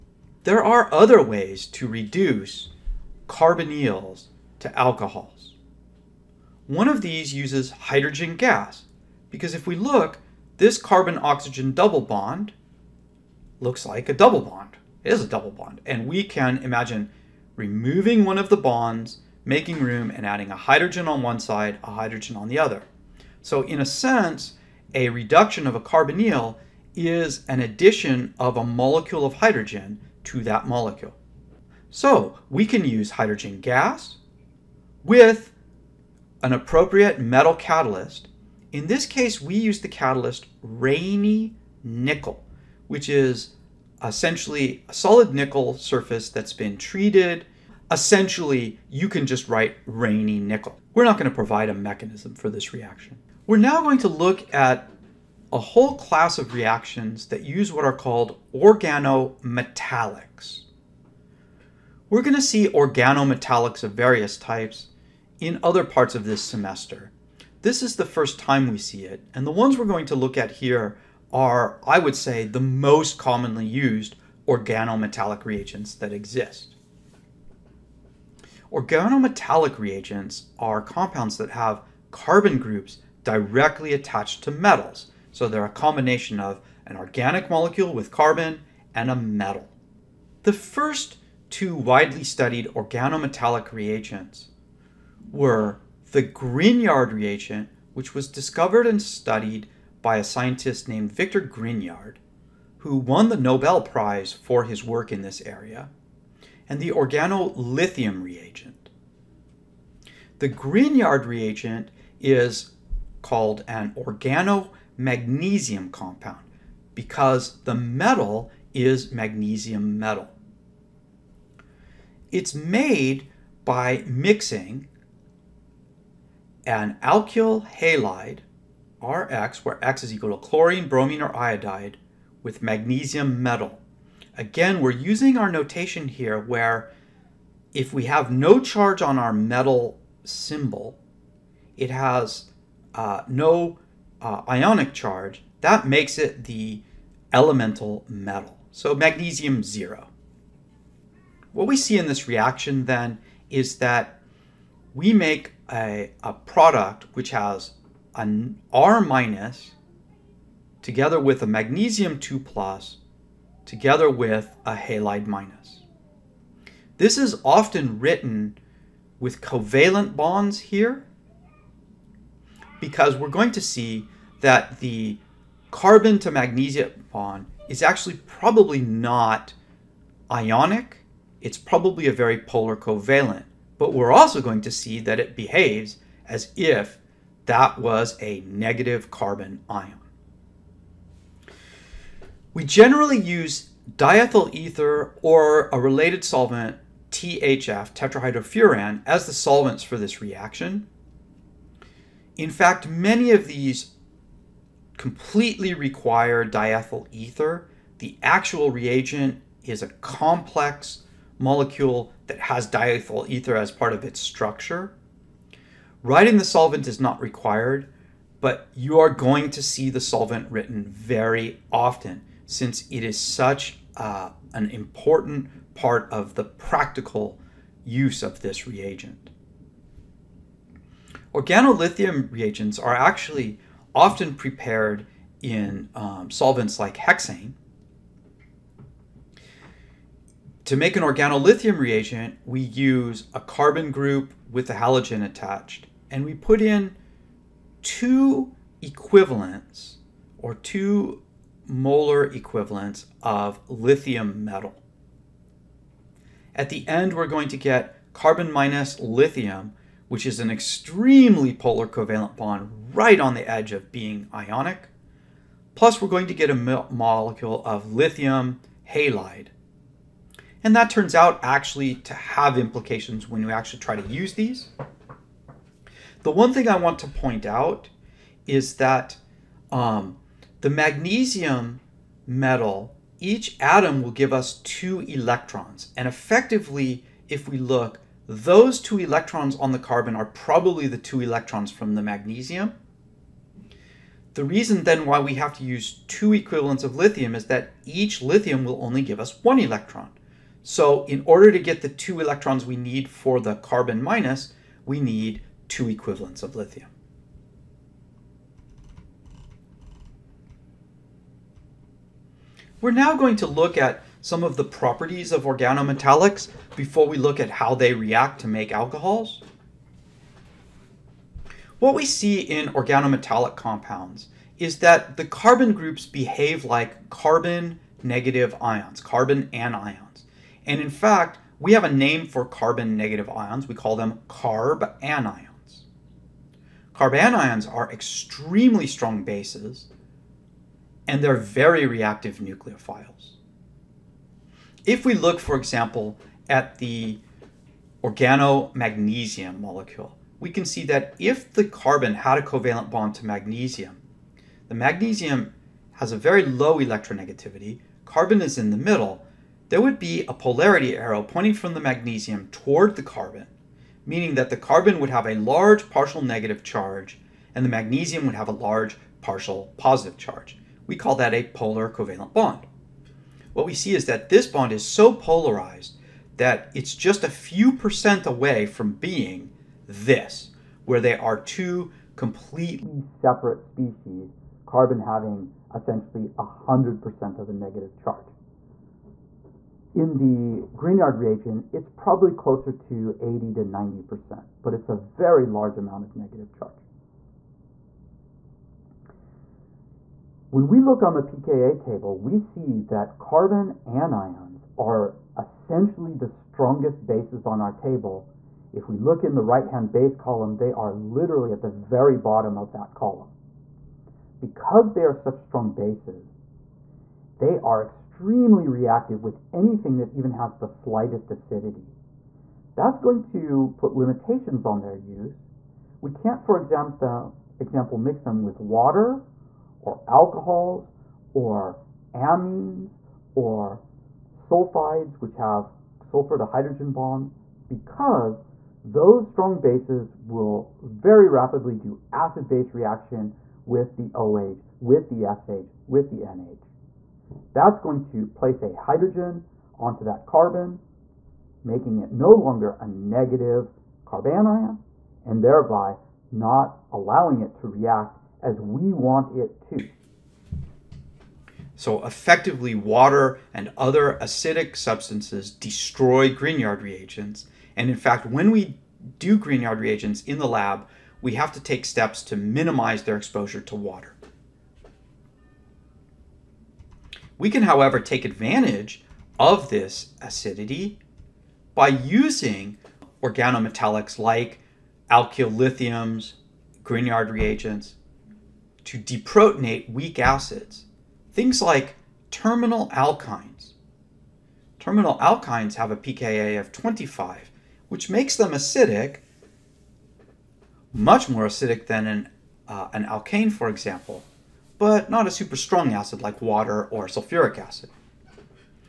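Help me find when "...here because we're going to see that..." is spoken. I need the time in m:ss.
2:50.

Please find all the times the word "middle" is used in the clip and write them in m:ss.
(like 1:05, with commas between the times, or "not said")
5:58.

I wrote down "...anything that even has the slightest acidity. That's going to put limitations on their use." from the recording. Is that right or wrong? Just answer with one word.
right.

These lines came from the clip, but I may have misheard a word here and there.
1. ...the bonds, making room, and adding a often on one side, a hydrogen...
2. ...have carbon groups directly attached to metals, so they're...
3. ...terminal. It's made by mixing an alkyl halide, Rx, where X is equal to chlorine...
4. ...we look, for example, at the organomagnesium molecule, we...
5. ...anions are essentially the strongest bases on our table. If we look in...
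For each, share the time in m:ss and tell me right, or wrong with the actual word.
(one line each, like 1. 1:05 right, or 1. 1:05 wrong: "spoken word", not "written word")
1. 0:18 wrong: "hydrogen", not "often"
2. 1:21 right
3. 1:59 wrong: "metal", not "terminal"
4. 5:45 right
5. 6:43 right.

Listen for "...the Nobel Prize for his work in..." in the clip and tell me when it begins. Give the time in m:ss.
1:43.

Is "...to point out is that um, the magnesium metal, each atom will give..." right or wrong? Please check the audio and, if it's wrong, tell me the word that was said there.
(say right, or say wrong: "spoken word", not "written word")
right.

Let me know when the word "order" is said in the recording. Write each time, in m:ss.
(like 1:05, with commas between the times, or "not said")
5:01.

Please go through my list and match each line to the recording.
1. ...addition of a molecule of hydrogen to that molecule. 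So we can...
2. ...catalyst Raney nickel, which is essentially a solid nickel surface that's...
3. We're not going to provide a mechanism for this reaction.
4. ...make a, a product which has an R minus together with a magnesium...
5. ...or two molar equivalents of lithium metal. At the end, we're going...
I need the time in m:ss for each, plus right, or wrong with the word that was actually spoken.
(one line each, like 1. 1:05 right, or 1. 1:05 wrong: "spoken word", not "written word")
1. 0:27 right
2. 0:39 right
3. 0:50 right
4. 2:35 right
5. 4:10 right.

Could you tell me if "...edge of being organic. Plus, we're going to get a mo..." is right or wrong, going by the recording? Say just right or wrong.
wrong.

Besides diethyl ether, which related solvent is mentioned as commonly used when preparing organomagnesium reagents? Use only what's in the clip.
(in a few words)
THF (tetrahydrofuran).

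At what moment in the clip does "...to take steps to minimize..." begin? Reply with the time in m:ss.
7:51.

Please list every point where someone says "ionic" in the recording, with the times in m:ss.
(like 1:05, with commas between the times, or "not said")
2:24, 3:00, 4:24.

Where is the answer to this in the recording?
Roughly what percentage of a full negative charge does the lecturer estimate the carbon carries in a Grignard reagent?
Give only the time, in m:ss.
6:33.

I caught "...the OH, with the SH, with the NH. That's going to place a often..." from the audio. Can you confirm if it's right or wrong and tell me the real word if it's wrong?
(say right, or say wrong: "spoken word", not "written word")
wrong: "hydrogen", not "often".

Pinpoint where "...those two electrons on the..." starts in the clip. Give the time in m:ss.
4:48.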